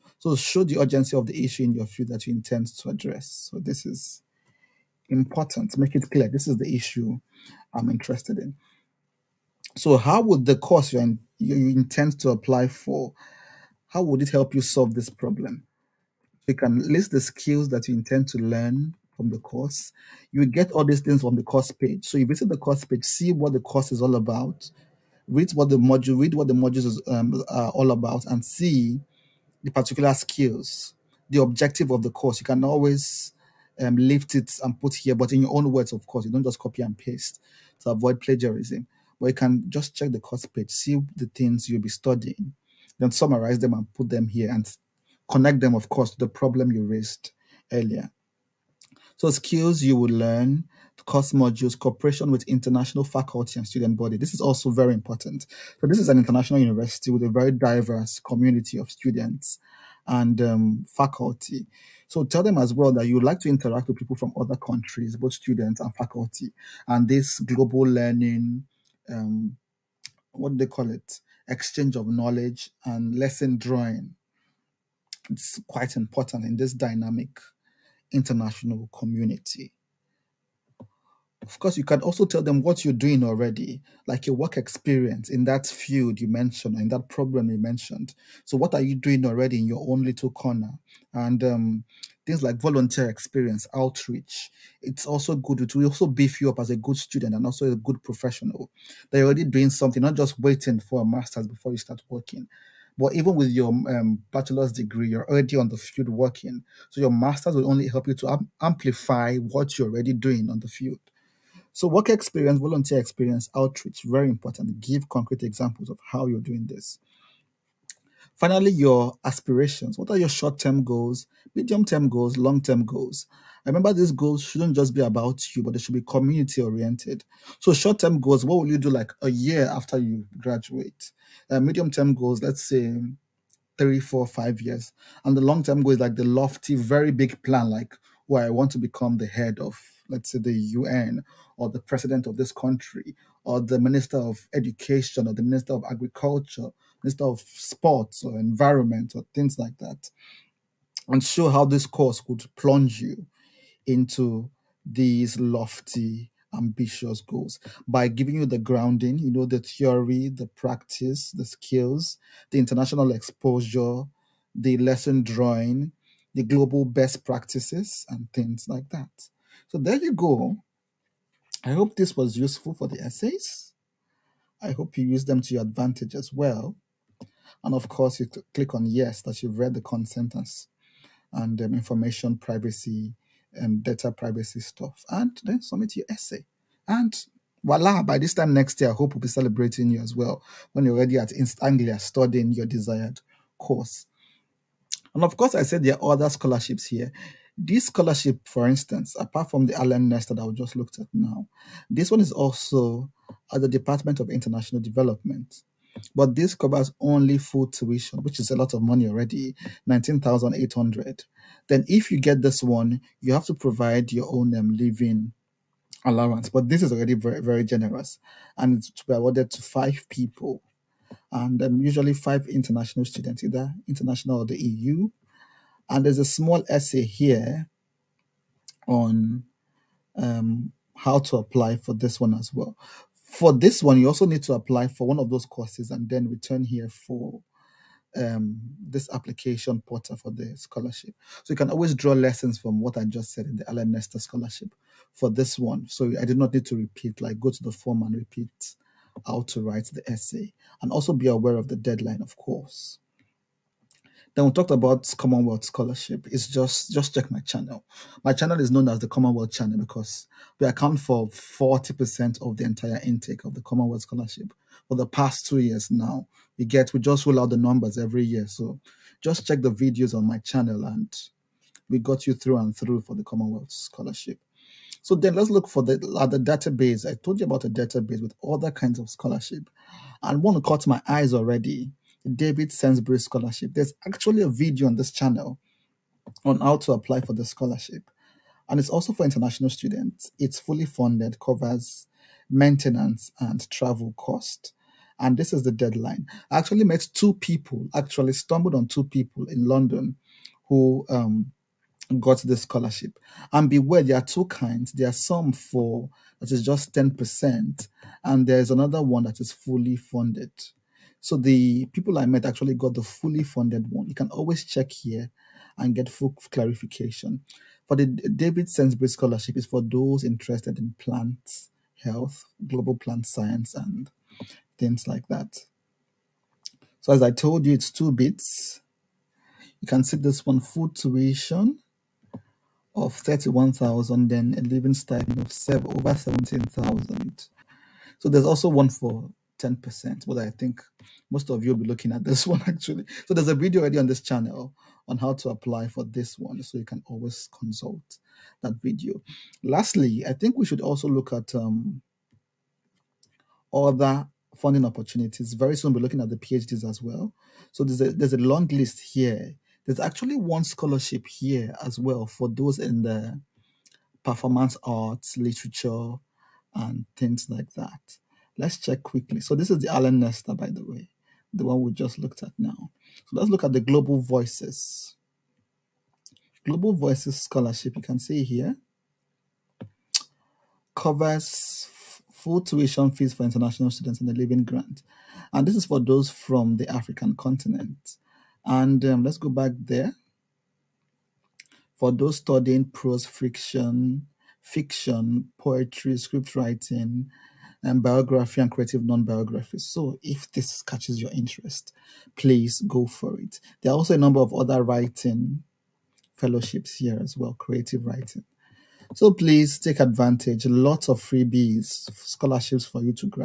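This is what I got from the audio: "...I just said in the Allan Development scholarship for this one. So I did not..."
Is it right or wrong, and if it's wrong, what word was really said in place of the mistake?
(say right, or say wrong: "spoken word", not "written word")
wrong: "Nesta", not "Development".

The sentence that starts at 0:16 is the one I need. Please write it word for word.
You can list the skills that you intend to learn from the course.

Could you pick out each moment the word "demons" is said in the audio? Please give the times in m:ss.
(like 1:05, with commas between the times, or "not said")
not said.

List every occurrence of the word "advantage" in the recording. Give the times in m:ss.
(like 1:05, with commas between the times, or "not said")
2:55, 6:50.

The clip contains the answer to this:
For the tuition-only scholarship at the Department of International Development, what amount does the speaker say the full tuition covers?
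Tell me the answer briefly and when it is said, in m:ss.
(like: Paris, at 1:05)
19,800, at 3:29.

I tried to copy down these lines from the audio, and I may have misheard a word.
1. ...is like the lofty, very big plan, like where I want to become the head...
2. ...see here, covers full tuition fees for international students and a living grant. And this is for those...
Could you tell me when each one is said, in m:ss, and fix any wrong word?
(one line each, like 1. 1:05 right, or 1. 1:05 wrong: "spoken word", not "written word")
1. 2:15 right
2. 6:18 right.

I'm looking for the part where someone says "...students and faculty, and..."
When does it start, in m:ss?
1:05.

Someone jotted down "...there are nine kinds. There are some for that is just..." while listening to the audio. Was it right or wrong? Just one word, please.
wrong.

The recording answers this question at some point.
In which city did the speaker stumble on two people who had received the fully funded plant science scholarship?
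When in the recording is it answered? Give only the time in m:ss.
4:59.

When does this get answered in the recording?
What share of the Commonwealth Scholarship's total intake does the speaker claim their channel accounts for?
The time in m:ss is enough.
4:21.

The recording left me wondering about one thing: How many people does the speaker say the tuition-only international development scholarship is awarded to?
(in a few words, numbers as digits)
5.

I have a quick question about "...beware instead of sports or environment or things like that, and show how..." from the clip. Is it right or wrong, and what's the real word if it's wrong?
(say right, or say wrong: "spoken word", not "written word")
wrong: "agriculture", not "beware".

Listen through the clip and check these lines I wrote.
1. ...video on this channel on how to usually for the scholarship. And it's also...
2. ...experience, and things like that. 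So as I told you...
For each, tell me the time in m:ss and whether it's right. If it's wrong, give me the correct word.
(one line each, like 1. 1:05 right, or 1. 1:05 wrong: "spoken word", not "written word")
1. 4:44 wrong: "apply", not "usually"
2. 5:23 wrong: "science", not "experience".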